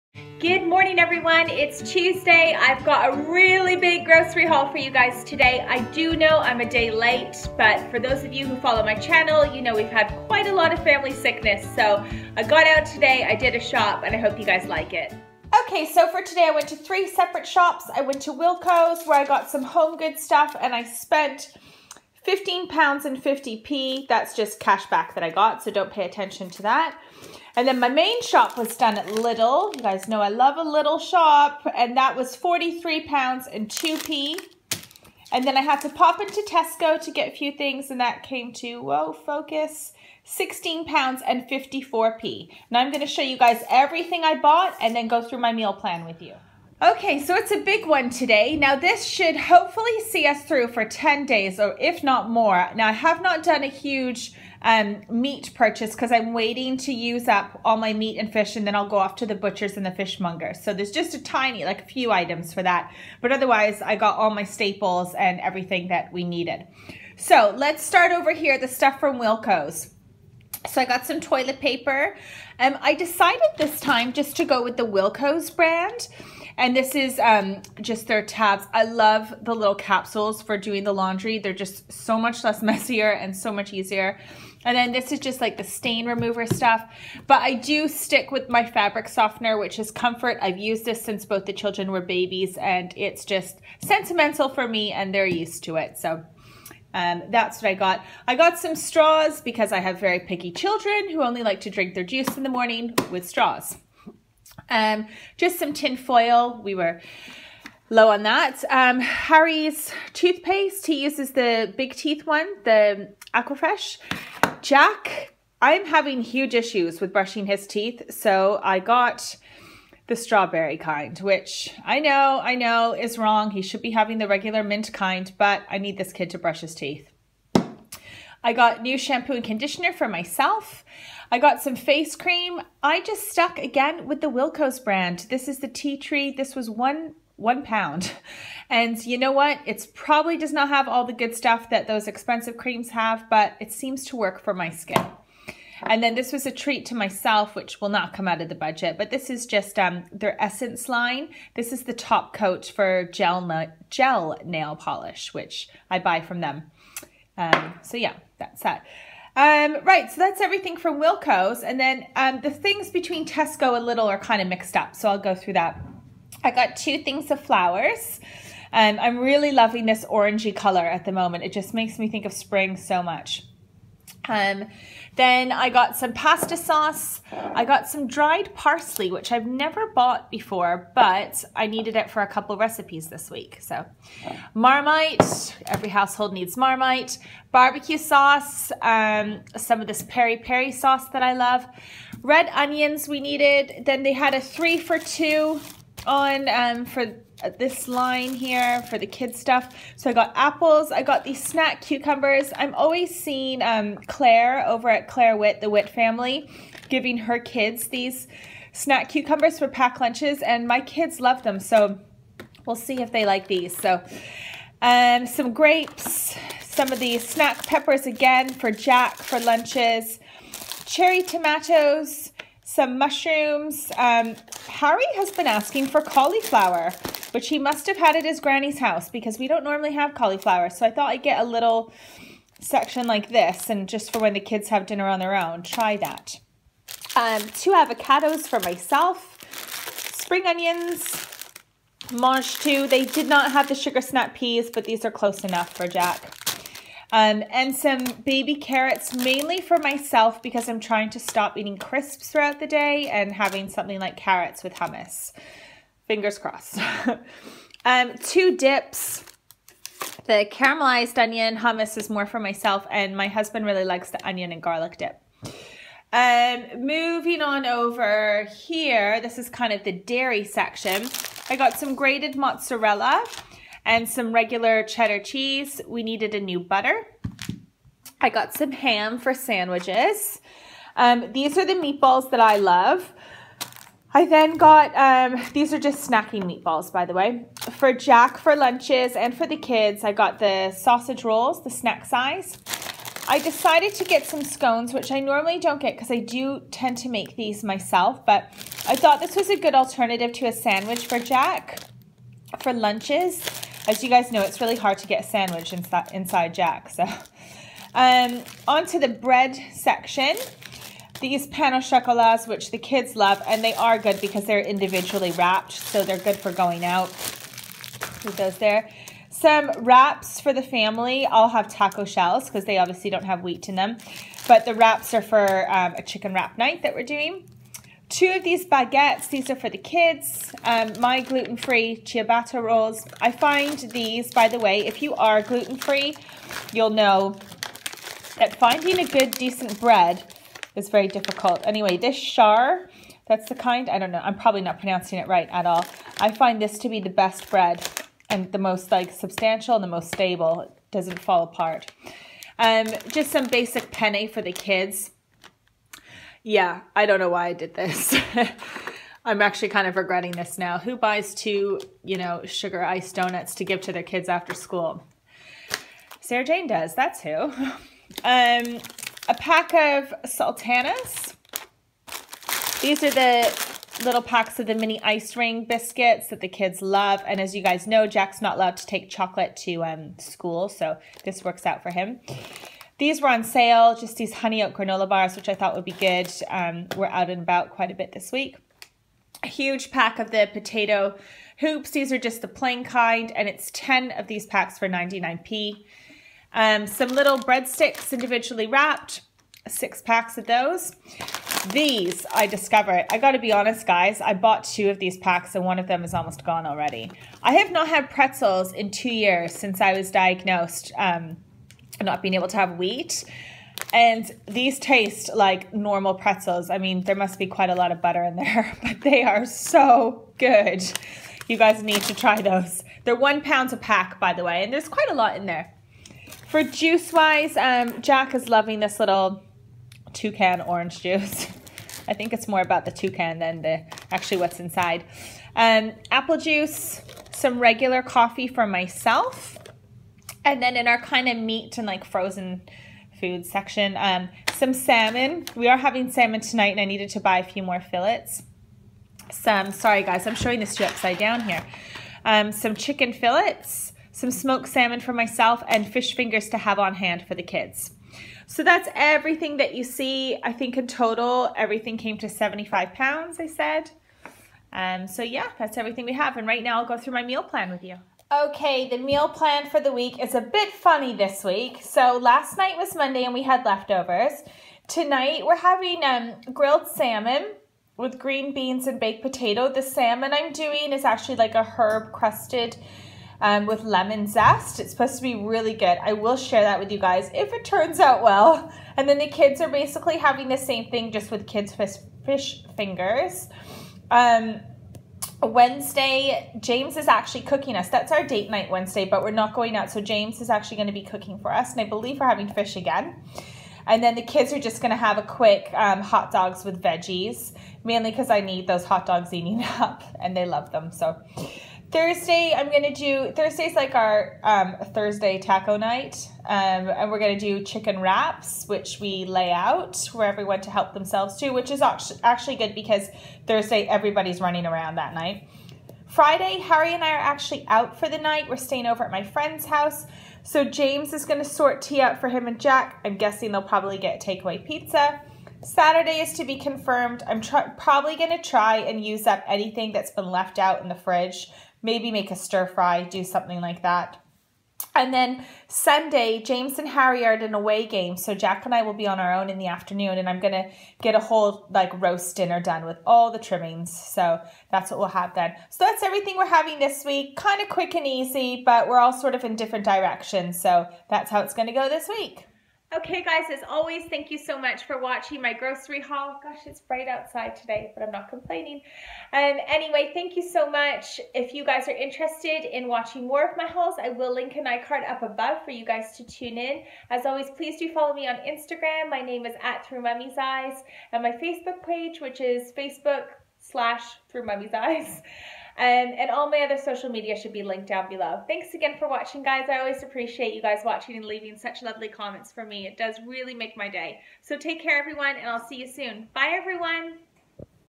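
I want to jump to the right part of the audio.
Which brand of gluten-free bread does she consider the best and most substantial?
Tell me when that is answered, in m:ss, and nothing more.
5:42.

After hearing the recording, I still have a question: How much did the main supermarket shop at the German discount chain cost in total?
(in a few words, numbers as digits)
£43.02.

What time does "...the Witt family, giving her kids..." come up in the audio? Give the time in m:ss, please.
3:25.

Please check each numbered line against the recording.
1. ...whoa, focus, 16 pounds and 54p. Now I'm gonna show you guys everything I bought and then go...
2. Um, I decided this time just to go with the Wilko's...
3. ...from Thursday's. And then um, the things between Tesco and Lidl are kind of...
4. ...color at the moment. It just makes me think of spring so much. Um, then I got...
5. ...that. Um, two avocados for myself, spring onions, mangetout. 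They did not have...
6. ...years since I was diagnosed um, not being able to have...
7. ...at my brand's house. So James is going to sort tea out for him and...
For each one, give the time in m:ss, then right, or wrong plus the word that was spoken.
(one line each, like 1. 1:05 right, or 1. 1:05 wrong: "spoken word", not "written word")
1. 0:38 right
2. 1:12 right
3. 2:40 wrong: "Wilko", not "Thursday"
4. 2:50 right
5. 3:55 right
6. 6:49 right
7. 8:49 wrong: "friend", not "brand".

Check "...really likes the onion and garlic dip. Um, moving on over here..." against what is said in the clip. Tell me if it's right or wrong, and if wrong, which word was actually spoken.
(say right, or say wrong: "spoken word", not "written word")
right.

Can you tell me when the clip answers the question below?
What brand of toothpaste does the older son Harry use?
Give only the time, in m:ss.
1:53.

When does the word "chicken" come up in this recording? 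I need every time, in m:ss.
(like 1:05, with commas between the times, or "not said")
5:26, 7:32, 8:37.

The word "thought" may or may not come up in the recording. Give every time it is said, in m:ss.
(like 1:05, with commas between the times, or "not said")
3:50, 4:58, 6:25.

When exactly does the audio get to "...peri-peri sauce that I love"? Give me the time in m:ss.
3:10.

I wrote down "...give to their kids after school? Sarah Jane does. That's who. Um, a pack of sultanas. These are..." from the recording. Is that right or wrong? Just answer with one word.
right.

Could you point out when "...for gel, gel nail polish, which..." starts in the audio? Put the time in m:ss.
2:32.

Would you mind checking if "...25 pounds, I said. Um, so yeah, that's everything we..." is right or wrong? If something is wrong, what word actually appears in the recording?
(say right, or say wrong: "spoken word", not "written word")
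wrong: "75", not "25".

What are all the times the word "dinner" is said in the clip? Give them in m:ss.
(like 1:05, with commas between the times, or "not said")
3:54, 9:12.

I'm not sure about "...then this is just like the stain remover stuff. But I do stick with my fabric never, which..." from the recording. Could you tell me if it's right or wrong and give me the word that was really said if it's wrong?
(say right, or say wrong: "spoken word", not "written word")
wrong: "softener", not "never".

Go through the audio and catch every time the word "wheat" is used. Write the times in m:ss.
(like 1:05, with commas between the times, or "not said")
5:23, 6:52.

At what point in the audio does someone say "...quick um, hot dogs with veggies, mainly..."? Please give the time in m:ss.
8:25.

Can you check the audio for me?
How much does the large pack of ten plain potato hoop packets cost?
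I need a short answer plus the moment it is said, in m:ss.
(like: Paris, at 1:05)
99p, at 6:34.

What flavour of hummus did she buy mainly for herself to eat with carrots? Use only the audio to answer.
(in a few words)
Caramelized onion.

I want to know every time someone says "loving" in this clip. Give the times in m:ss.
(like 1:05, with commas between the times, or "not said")
2:49, 7:08.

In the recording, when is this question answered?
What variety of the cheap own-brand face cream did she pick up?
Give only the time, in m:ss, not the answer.
2:15.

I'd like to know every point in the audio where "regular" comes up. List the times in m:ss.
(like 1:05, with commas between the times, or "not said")
2:04, 4:34, 7:17.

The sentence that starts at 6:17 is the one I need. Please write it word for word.
And as you guys know, Jack's not allowed to take chocolate to um, school, so this works out for him.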